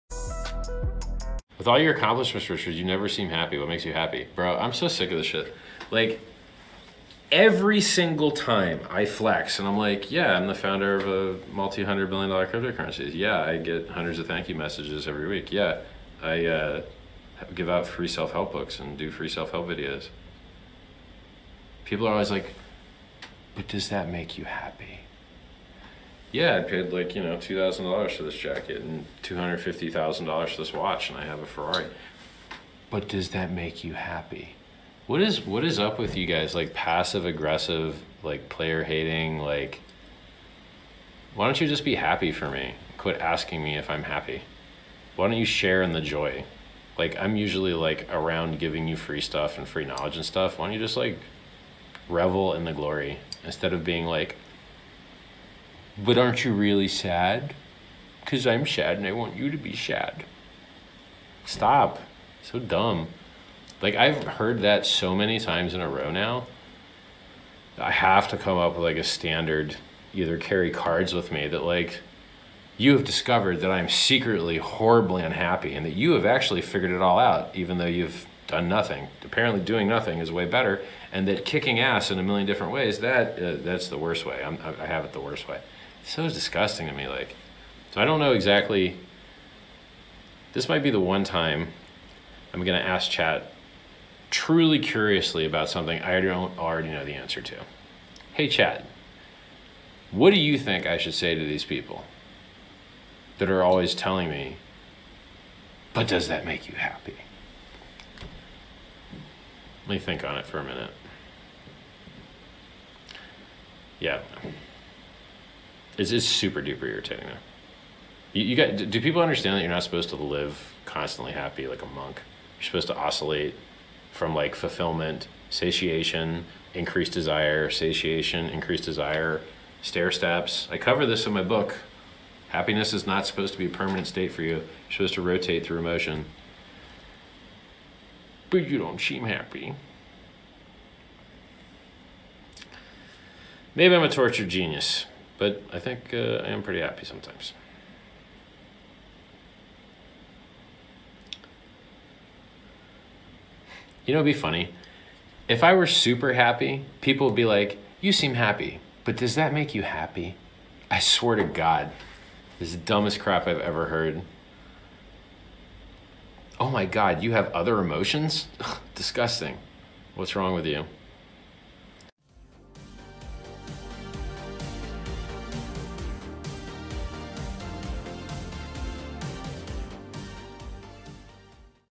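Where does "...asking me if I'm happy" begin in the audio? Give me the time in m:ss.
0:43.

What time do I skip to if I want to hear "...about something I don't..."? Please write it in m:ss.
1:35.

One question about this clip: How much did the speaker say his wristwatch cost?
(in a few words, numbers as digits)
$250,000.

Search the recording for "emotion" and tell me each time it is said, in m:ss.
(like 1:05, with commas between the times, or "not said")
2:15, 2:47.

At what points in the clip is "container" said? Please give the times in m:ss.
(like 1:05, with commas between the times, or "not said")
not said.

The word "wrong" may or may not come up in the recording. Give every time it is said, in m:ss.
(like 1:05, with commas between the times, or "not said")
2:50.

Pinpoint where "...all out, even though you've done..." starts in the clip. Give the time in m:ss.
1:17.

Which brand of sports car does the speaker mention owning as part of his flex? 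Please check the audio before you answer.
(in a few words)
Ferrari.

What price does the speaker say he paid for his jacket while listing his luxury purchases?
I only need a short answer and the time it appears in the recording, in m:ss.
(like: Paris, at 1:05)
$2,000, at 0:27.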